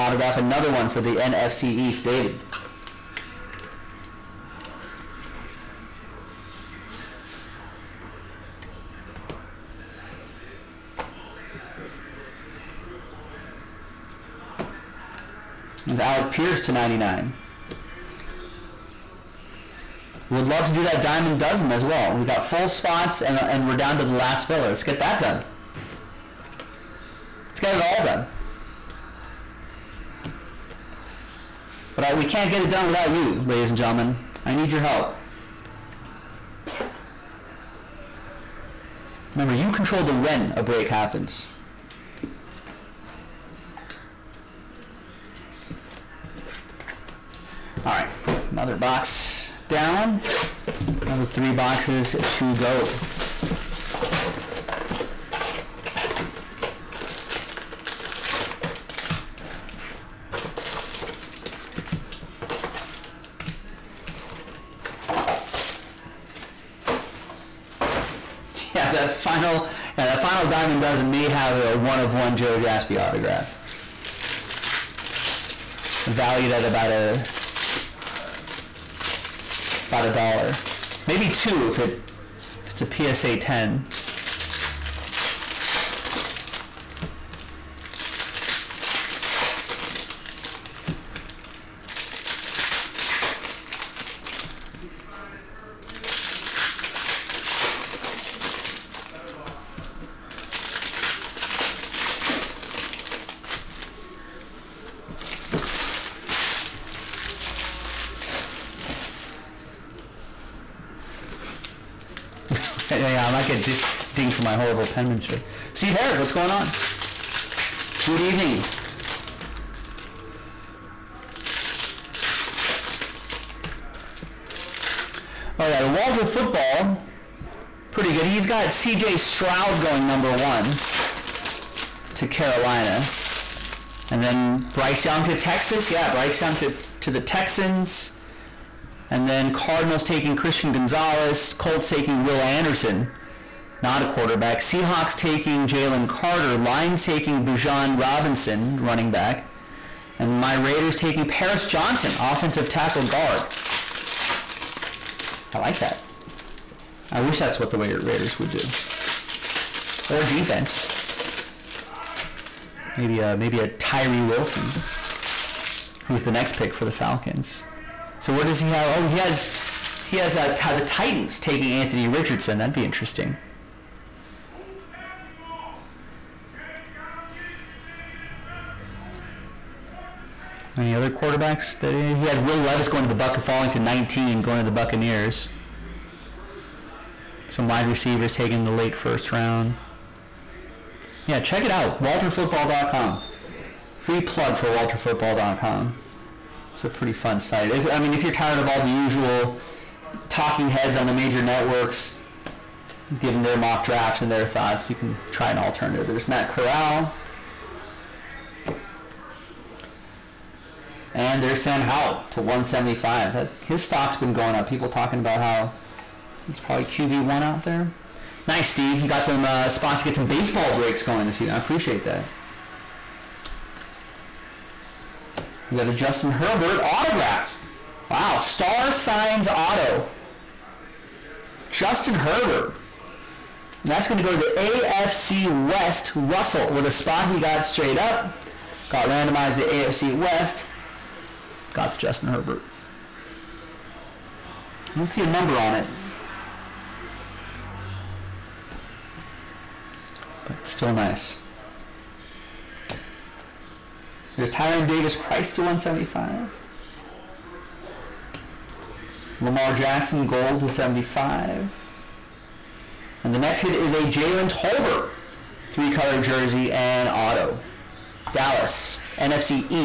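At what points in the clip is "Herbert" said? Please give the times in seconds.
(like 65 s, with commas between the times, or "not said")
226 s, 232 s, 242 s.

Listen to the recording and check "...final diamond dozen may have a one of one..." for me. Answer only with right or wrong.
right.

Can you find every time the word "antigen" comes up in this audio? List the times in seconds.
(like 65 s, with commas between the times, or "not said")
not said.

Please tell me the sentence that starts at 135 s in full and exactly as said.
Yeah, Bryce Young to, to the Texans.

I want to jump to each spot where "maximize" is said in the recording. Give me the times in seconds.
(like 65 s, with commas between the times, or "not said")
not said.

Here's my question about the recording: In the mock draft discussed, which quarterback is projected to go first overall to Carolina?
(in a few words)
C.J. Stroud.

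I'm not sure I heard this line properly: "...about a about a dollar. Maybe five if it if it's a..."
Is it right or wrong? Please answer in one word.
wrong.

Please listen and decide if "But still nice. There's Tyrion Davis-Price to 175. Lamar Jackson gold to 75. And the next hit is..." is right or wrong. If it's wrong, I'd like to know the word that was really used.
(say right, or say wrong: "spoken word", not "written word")
right.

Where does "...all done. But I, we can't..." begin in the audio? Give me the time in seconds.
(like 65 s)
27 s.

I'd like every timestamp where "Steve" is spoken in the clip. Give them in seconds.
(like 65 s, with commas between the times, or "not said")
115 s, 218 s.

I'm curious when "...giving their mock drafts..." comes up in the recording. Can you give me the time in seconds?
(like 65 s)
203 s.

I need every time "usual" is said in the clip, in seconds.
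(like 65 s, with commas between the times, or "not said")
198 s.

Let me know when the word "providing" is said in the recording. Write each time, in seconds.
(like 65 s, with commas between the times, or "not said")
not said.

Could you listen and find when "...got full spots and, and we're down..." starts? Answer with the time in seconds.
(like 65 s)
22 s.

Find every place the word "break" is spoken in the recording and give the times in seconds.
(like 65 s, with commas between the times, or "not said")
40 s, 220 s.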